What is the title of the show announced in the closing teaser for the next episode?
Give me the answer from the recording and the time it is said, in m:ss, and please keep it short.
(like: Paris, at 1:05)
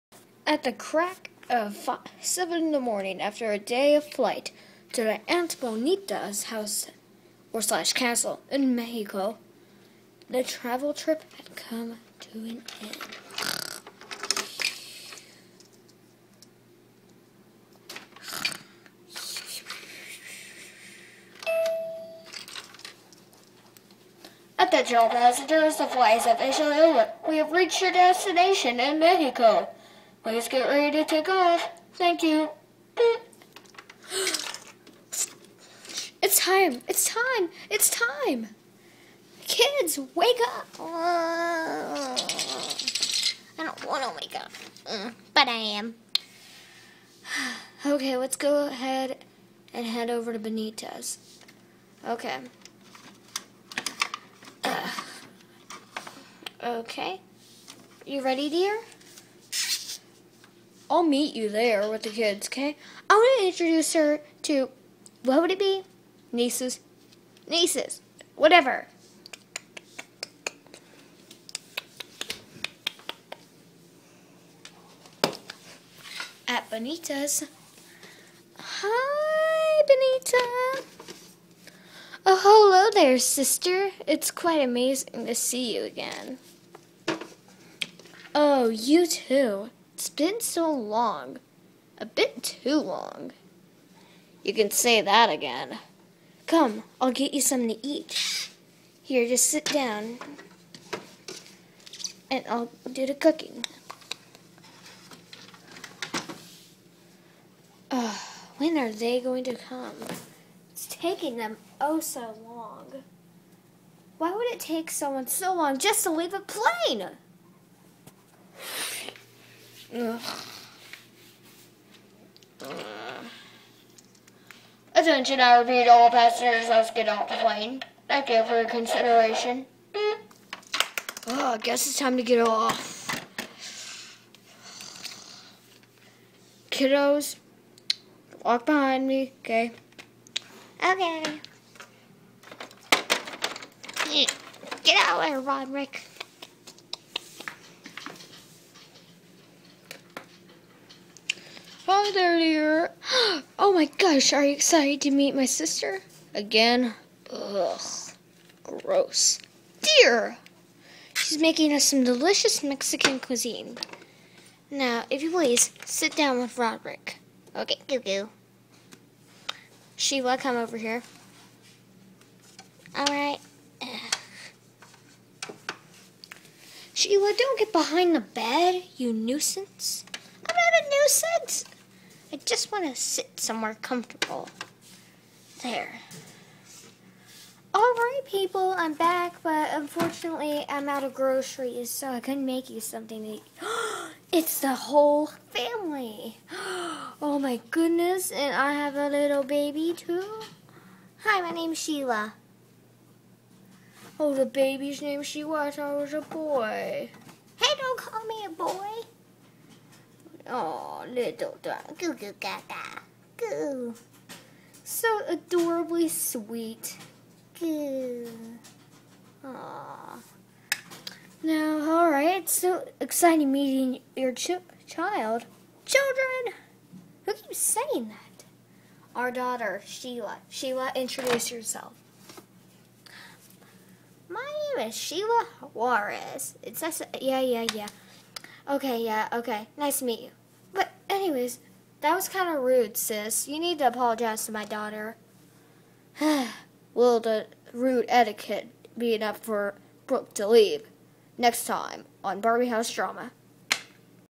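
Barbie House Drama, at 4:12.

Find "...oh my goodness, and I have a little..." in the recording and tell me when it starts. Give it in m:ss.
3:17.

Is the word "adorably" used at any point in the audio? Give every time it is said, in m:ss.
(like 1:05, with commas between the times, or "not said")
3:35.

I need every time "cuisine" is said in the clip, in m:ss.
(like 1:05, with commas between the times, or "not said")
2:43.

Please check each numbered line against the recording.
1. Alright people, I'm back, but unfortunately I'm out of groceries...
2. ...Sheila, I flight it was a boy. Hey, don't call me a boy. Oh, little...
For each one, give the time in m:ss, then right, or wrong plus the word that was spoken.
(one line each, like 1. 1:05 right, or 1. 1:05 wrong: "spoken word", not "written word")
1. 3:07 right
2. 3:25 wrong: "thought", not "flight".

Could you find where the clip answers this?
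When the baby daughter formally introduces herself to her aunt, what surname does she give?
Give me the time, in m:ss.
3:55.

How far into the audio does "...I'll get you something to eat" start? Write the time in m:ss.
1:36.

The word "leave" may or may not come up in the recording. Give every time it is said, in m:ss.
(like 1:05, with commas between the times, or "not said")
1:56, 4:10.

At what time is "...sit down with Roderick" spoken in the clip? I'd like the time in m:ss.
2:45.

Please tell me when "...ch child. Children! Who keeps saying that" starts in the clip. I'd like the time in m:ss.
3:44.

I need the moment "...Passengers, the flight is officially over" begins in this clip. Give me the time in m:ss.
0:25.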